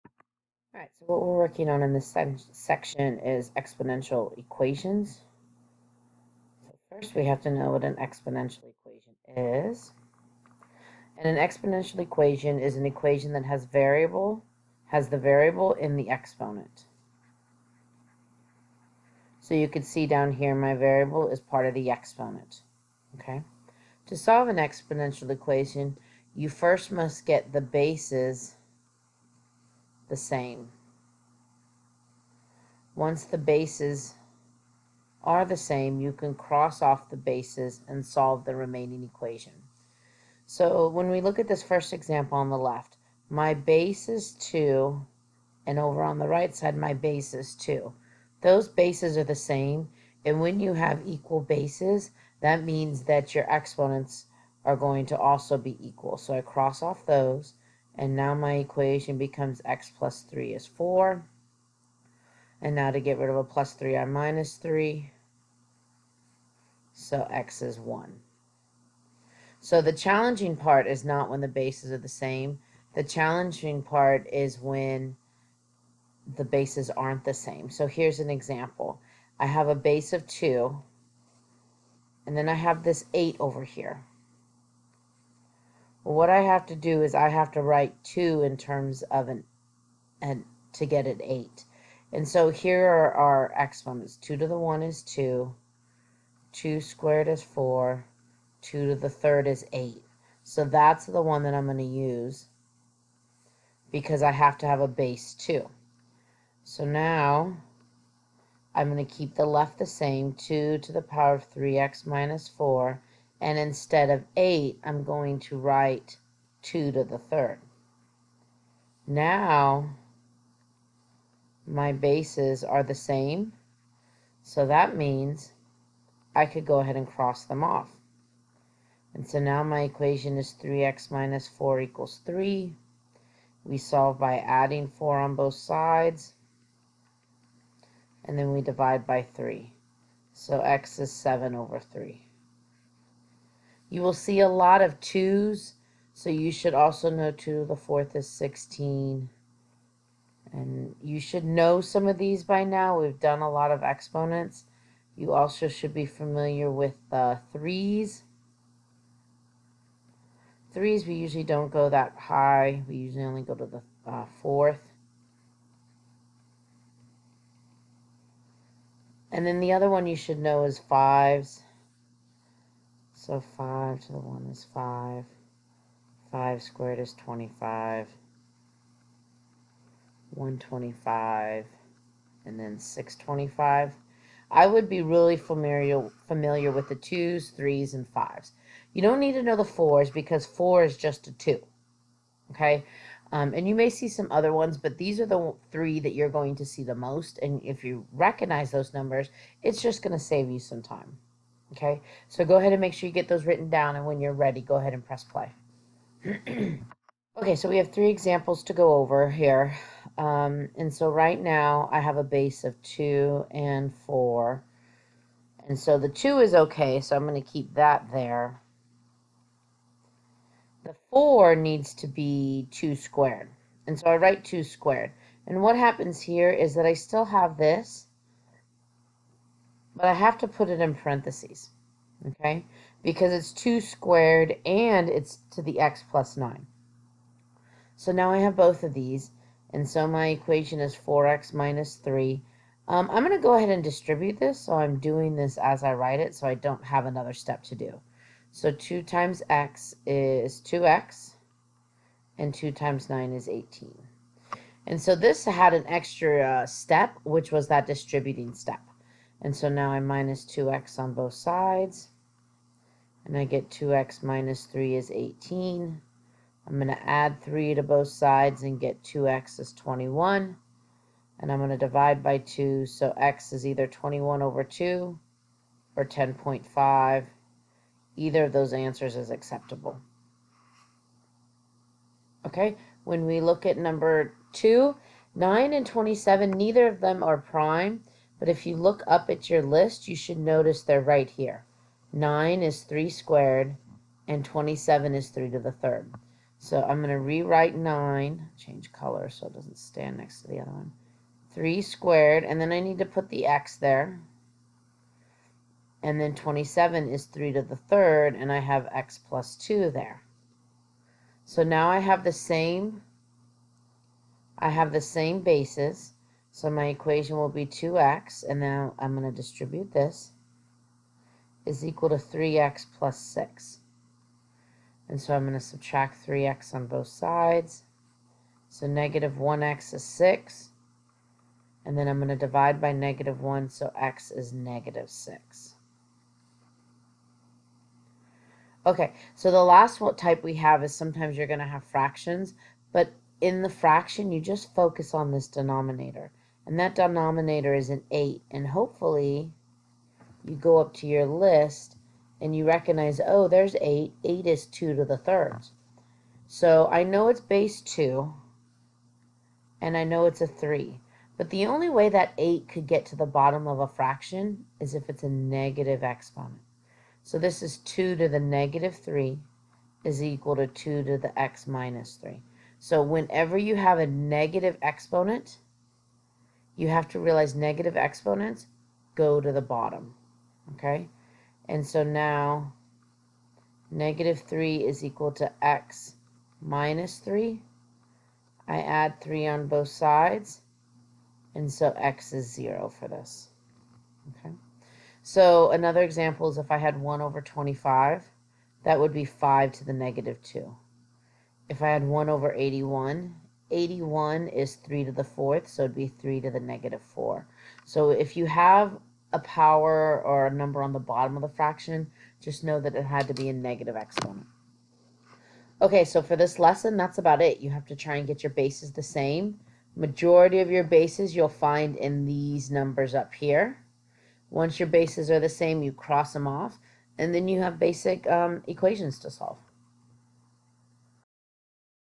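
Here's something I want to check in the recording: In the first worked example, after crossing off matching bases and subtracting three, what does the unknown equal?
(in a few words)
x = 1.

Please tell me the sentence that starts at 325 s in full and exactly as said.
And so I'm going to subtract 3x on both sides.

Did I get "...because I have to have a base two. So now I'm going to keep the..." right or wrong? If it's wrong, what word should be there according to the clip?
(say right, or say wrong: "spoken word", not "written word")
right.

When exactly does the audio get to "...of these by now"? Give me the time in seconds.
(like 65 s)
152 s.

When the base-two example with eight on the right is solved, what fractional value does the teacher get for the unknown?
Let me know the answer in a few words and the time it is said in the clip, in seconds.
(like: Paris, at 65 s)
7/3, at 141 s.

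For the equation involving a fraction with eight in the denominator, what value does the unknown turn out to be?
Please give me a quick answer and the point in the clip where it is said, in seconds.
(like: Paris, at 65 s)
0, at 391 s.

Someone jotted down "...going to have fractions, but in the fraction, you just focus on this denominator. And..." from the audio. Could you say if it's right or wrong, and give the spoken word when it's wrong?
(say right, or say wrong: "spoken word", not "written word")
right.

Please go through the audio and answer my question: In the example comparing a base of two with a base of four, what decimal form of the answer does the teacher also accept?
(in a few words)
10.5.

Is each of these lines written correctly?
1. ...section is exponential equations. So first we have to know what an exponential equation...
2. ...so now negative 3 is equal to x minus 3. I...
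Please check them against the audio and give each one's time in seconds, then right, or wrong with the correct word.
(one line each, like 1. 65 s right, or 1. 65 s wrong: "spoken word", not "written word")
1. 2 s right
2. 381 s right.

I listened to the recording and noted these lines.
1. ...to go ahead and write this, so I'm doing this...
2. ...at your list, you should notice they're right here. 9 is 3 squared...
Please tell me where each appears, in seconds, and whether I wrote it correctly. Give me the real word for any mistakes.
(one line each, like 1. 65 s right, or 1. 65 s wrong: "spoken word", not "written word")
1. 243 s wrong: "distribute", not "write"
2. 289 s right.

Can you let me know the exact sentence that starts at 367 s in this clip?
So this is 2 to the negative 3 is equal to 2 to the x minus 3.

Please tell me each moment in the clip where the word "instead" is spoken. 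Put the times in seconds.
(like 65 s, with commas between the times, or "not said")
113 s.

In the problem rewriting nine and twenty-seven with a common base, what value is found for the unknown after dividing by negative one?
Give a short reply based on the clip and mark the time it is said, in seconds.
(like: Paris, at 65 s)
-6, at 334 s.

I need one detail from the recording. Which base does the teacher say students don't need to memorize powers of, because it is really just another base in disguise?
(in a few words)
4.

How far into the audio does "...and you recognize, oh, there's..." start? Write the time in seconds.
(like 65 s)
352 s.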